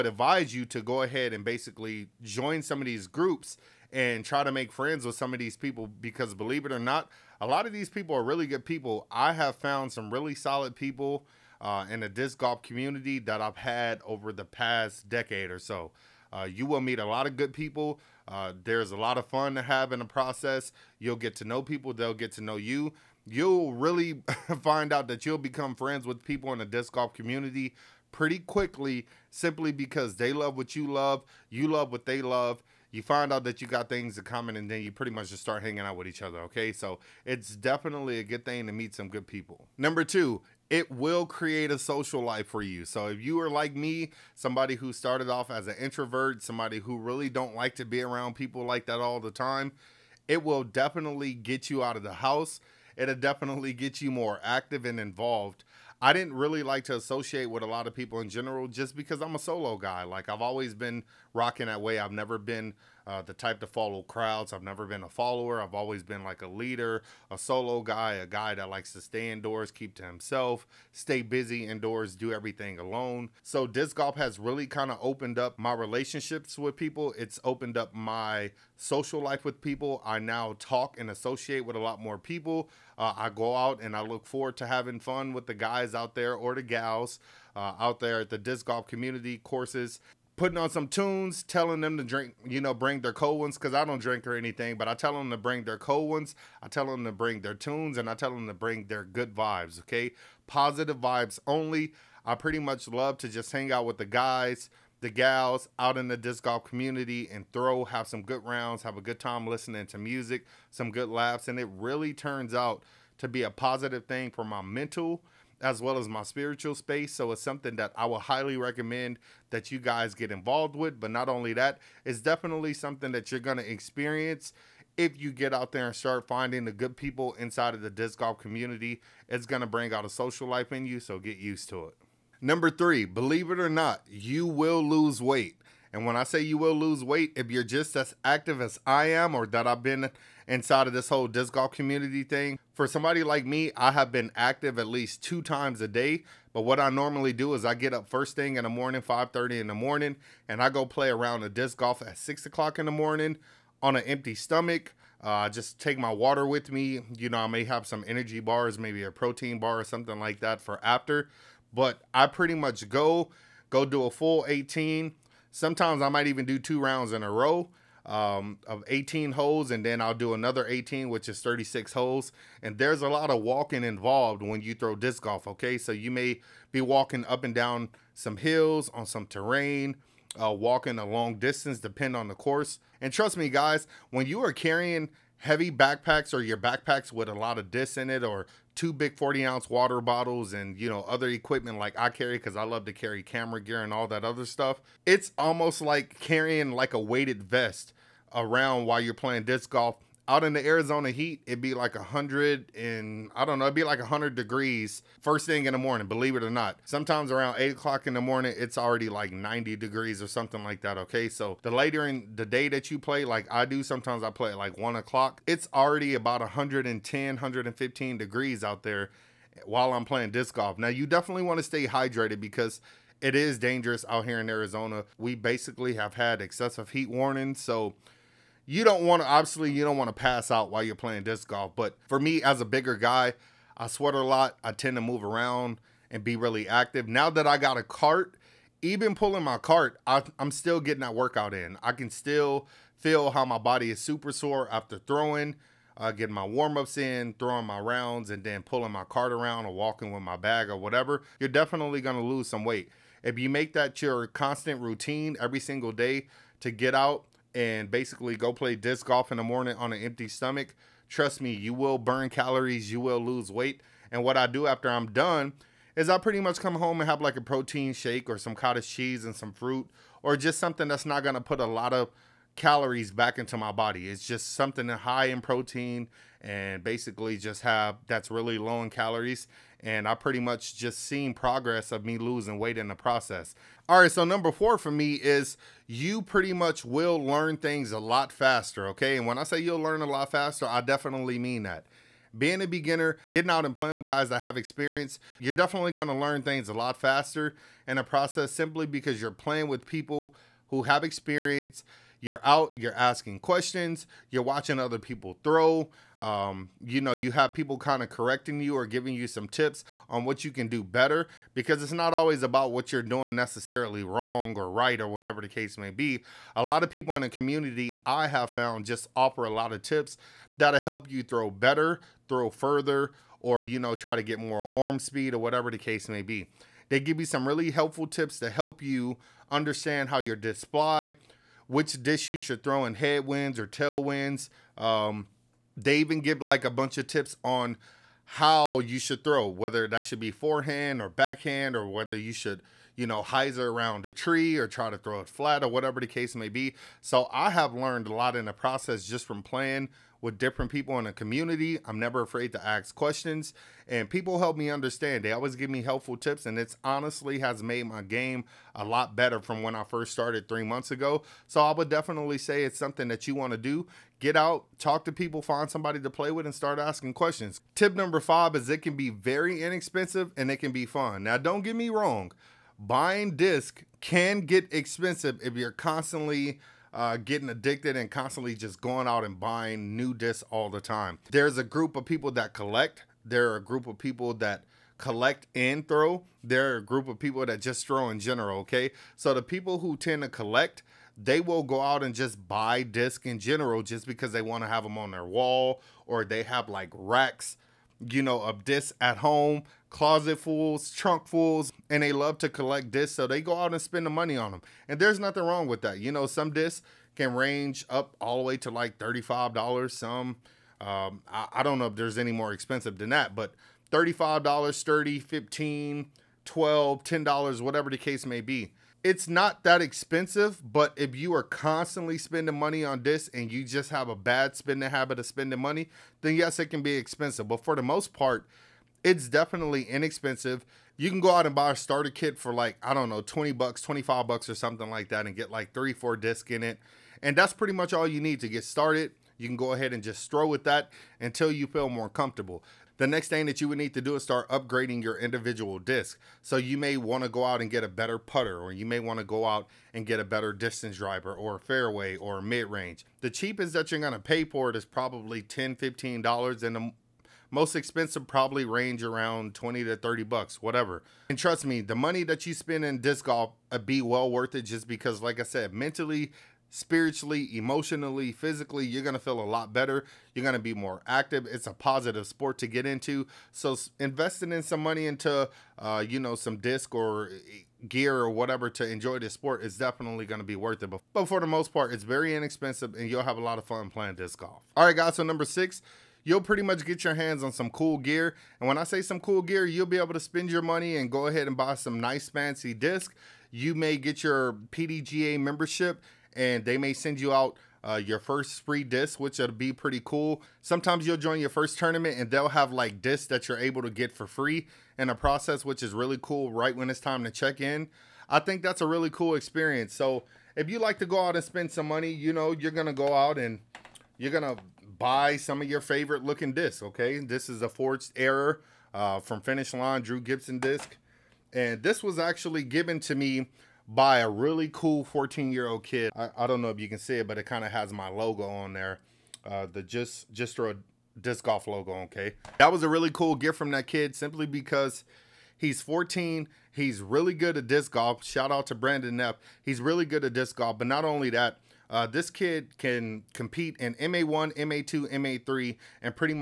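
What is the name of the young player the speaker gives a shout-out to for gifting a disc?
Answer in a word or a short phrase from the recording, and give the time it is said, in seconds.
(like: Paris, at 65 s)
Brandon Neff, at 538 s.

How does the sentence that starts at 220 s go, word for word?
Now you definitely want to stay hydrated because it is dangerous out here in Arizona.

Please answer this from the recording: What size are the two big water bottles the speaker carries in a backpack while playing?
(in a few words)
40 ounce.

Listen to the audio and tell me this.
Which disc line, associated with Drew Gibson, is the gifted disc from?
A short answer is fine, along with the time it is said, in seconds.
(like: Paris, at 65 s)
Finish Line, at 519 s.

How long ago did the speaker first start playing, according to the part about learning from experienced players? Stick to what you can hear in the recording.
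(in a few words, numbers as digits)
3 months.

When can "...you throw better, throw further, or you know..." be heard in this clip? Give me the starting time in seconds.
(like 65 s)
321 s.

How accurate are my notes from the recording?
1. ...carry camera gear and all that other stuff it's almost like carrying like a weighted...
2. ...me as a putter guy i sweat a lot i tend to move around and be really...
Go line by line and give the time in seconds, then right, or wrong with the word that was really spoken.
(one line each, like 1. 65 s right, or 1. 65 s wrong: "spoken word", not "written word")
1. 192 s right
2. 232 s wrong: "bigger", not "putter".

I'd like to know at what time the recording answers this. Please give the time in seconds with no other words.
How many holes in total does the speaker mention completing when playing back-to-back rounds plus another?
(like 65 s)
171 s.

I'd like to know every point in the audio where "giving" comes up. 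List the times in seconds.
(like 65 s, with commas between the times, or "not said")
308 s.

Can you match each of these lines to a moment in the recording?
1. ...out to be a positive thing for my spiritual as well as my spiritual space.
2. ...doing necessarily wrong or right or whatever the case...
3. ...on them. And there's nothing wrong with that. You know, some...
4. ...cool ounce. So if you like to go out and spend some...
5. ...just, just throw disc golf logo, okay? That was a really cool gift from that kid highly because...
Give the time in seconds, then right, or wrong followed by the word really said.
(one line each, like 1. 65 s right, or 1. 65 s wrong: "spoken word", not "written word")
1. 112 s wrong: "mental", not "spiritual"
2. 313 s right
3. 404 s right
4. 509 s wrong: "experience", not "ounce"
5. 529 s wrong: "simply", not "highly".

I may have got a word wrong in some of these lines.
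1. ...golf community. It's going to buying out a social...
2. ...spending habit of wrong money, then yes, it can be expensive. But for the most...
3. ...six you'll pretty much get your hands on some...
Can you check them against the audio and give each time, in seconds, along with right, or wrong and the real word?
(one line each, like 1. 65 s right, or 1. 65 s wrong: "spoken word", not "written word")
1. 128 s wrong: "bring", not "buying"
2. 424 s wrong: "spending", not "wrong"
3. 485 s right.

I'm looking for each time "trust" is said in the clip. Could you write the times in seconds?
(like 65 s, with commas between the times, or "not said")
183 s, 261 s, 461 s.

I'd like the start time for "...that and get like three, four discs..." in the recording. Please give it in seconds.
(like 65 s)
435 s.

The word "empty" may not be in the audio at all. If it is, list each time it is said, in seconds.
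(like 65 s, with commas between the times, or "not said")
154 s, 260 s.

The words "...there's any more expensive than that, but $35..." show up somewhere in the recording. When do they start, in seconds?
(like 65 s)
411 s.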